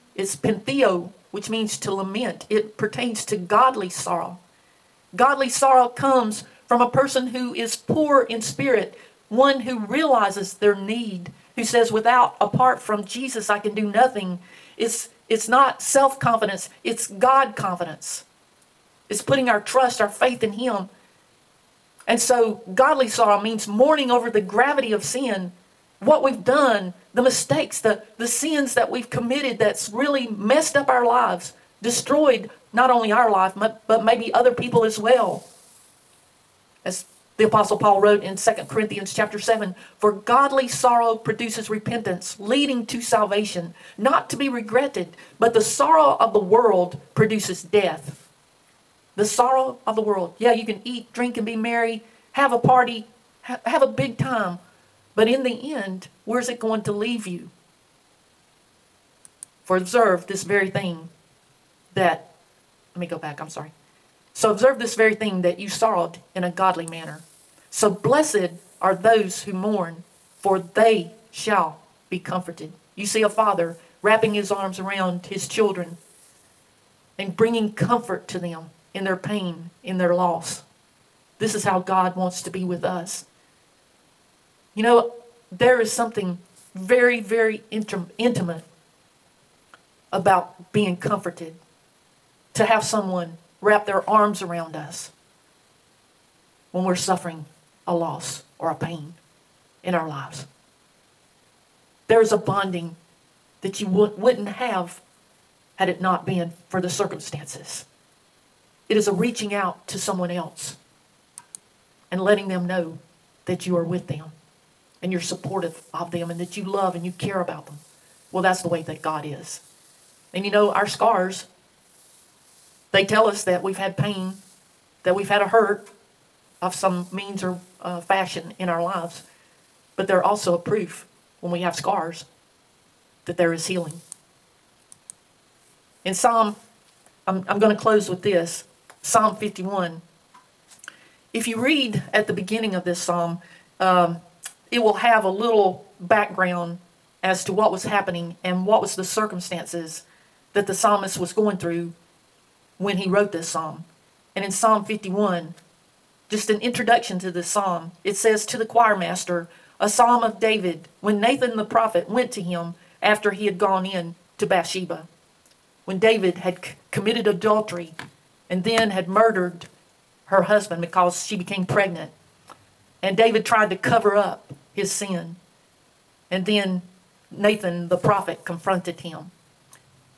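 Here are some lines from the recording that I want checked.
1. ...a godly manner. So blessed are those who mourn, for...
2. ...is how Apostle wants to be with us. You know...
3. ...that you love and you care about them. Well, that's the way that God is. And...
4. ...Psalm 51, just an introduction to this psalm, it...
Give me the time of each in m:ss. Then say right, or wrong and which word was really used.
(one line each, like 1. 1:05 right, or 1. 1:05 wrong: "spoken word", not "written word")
1. 1:06 right
2. 1:21 wrong: "God", not "Apostle"
3. 1:56 right
4. 2:34 right.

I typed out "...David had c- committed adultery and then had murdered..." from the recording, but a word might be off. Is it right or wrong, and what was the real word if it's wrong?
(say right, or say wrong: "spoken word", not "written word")
right.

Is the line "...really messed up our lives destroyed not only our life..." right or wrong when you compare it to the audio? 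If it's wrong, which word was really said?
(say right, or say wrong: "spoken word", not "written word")
right.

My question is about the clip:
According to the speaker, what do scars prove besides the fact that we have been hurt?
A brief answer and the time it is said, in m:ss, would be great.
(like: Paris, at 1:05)
healing, at 2:13.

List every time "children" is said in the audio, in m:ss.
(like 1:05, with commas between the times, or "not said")
1:15.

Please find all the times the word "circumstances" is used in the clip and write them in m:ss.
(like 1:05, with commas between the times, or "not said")
1:46, 2:29.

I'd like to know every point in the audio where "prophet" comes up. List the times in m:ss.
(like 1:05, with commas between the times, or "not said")
2:41, 2:57.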